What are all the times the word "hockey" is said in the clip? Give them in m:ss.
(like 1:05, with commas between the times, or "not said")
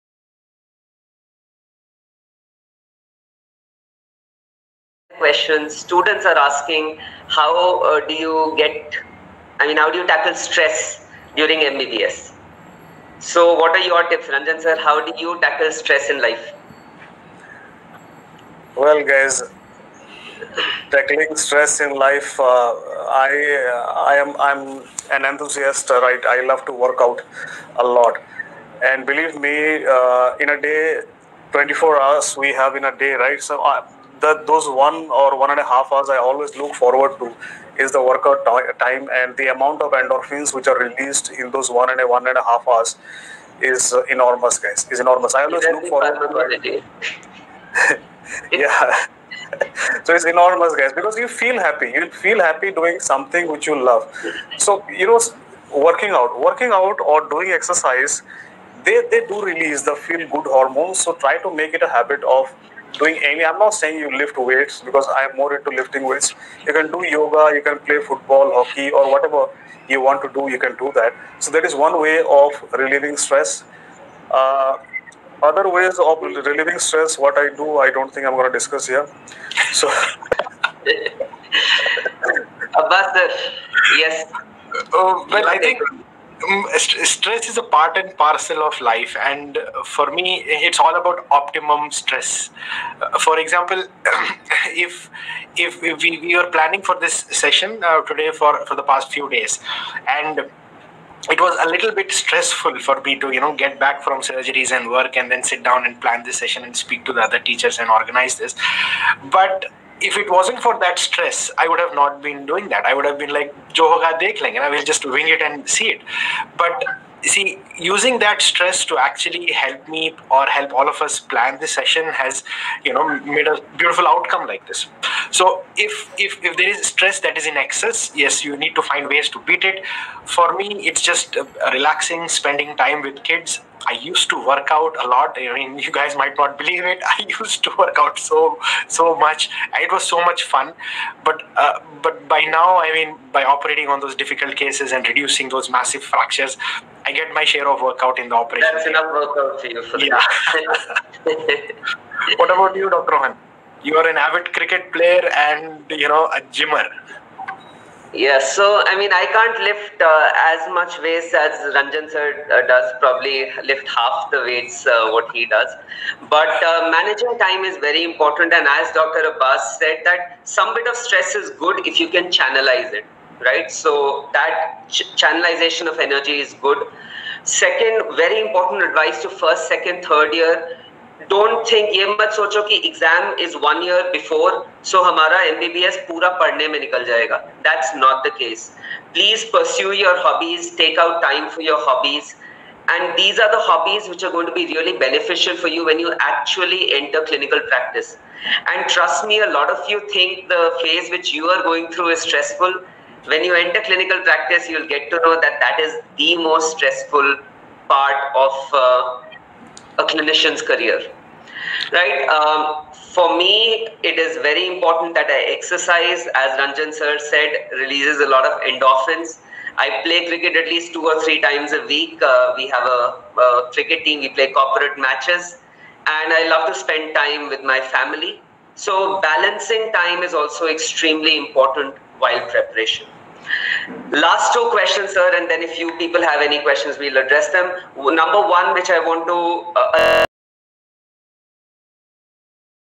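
1:08.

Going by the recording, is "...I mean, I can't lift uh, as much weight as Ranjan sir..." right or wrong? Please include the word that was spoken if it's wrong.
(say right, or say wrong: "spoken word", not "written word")
right.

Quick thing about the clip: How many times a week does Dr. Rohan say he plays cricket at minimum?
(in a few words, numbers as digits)
2 or 3.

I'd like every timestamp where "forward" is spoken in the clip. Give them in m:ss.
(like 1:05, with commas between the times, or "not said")
0:36, 0:45.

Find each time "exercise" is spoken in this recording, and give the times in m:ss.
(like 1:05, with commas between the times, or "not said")
0:57, 3:35.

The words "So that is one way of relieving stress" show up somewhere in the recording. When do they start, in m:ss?
1:11.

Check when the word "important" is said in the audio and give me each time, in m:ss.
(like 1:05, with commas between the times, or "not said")
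2:48, 2:58, 3:34, 3:51.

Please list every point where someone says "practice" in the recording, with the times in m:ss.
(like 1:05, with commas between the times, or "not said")
3:17, 3:24.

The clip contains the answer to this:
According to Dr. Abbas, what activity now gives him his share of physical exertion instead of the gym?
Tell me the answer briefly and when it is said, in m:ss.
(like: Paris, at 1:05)
Operating, at 2:28.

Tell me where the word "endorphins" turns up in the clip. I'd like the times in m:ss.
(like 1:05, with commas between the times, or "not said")
0:39, 3:38.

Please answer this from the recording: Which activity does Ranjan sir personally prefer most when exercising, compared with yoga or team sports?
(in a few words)
Lifting weights.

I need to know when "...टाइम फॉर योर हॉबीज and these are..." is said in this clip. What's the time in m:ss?
3:11.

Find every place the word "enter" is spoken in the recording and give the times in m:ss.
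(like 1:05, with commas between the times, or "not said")
3:16, 3:23.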